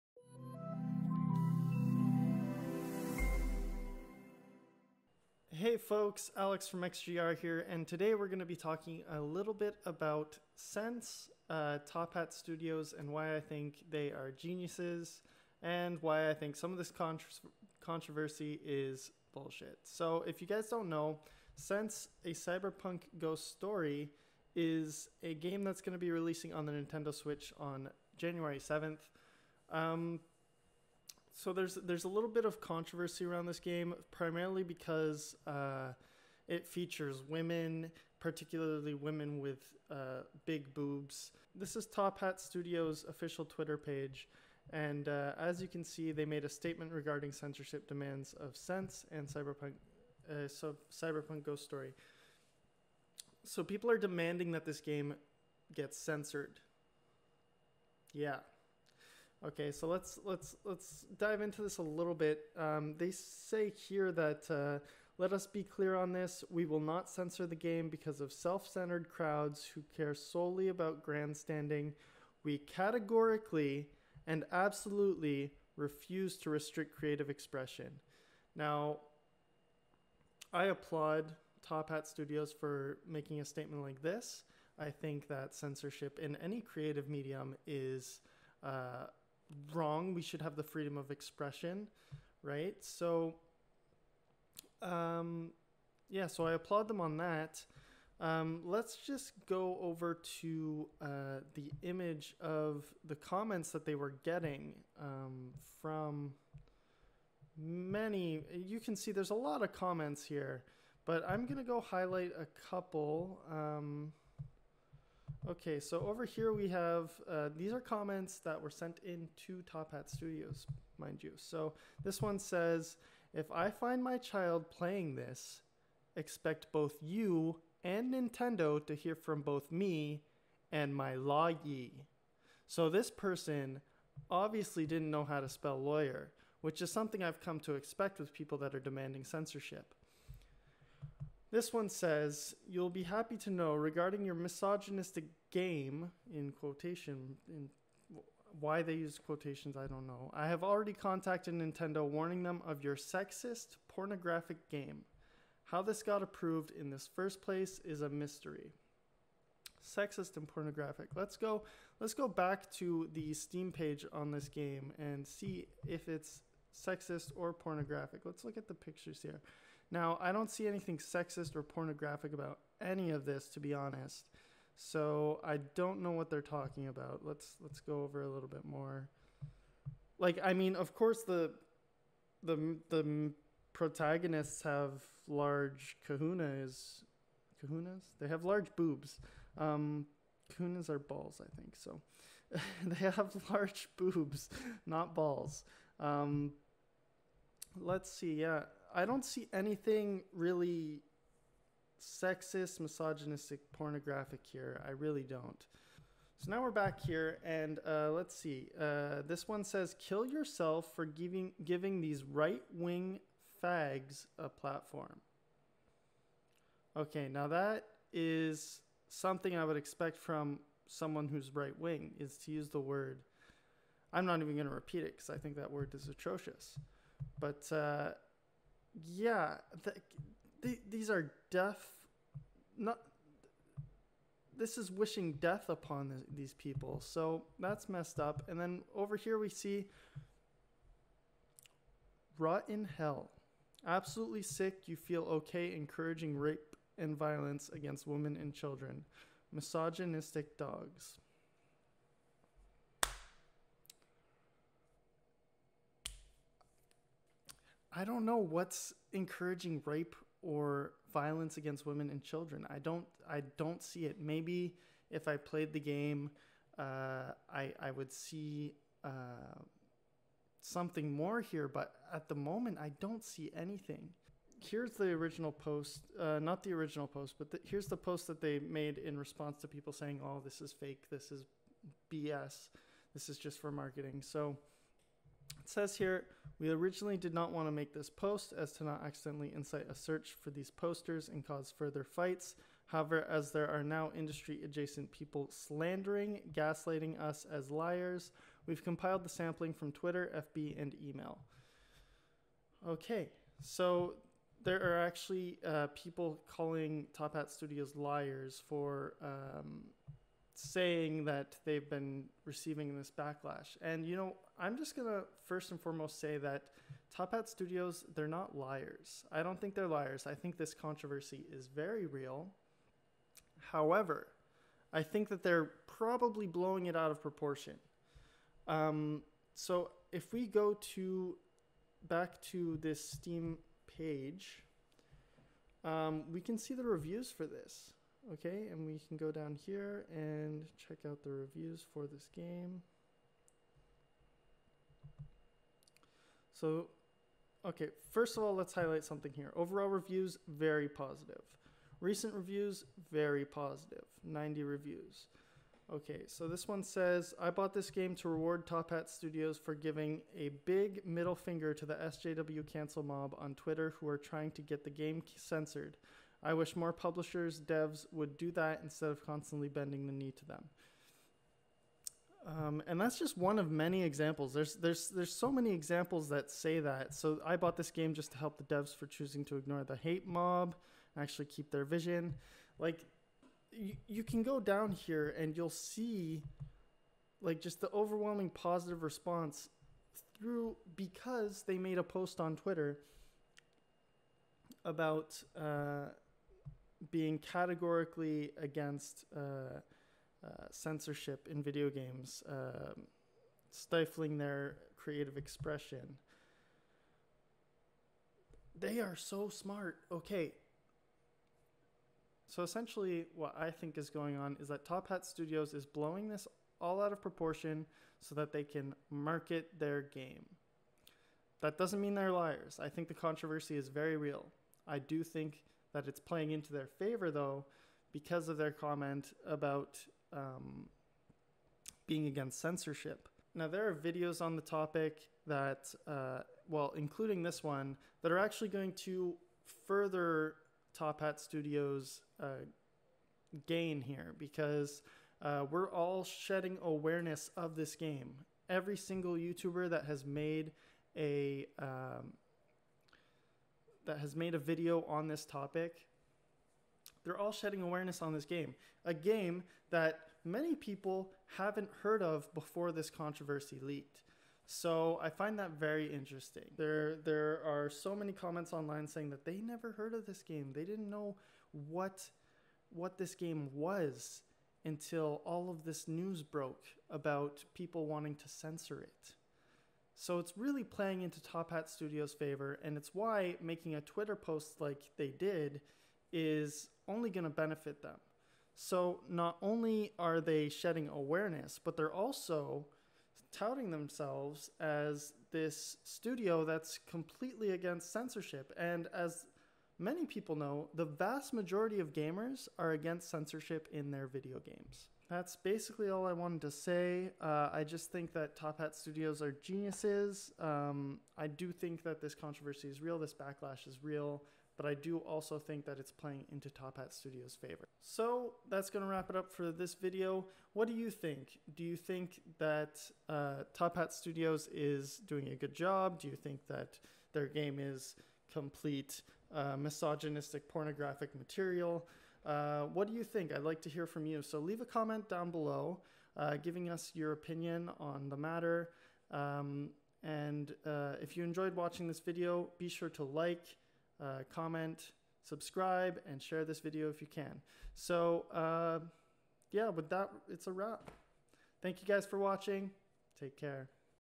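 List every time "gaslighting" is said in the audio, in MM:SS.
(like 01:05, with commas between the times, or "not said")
04:56.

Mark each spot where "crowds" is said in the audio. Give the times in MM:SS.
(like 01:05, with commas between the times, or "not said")
01:09.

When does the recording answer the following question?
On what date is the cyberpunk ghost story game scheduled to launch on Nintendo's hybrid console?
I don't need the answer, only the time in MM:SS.
00:28.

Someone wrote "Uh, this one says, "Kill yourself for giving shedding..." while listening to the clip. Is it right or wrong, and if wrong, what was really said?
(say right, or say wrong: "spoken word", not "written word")
wrong: "giving", not "shedding".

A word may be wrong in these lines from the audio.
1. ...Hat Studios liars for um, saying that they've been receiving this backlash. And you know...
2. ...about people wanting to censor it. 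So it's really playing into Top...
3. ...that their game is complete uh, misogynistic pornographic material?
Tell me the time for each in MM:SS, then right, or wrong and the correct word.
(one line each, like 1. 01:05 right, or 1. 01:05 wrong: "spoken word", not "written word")
1. 05:07 right
2. 07:57 right
3. 08:46 right.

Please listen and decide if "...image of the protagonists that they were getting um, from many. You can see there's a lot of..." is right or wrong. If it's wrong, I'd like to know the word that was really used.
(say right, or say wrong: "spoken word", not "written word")
wrong: "comments", not "protagonists".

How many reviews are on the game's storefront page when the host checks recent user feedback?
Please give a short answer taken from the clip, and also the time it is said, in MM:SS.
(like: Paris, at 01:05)
90, at 05:54.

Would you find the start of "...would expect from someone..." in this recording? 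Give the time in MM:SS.
03:39.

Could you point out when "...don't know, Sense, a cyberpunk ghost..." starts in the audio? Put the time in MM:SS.
00:20.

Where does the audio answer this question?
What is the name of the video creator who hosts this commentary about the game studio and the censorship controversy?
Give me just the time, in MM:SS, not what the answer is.
00:06.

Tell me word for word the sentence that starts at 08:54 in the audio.
So leave a comment down below, uh, giving us your opinion on the matter.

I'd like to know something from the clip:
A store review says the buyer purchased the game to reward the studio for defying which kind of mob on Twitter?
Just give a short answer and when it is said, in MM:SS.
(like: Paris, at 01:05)
SJW cancel mob, at 06:01.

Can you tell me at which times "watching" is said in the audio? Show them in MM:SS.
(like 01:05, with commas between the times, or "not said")
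09:01, 09:12.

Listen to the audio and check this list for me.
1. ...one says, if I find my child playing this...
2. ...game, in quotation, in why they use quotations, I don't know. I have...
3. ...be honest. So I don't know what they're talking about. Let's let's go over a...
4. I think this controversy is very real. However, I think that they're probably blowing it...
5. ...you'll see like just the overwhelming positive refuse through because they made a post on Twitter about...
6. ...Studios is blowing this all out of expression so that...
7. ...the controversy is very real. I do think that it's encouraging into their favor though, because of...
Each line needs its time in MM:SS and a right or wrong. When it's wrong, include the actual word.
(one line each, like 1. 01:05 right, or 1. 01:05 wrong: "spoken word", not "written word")
1. 02:02 right
2. 02:25 right
3. 02:53 right
4. 05:20 right
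5. 06:25 wrong: "response", not "refuse"
6. 06:55 wrong: "proportion", not "expression"
7. 07:03 wrong: "playing", not "encouraging".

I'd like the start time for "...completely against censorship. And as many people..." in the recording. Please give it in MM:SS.
08:17.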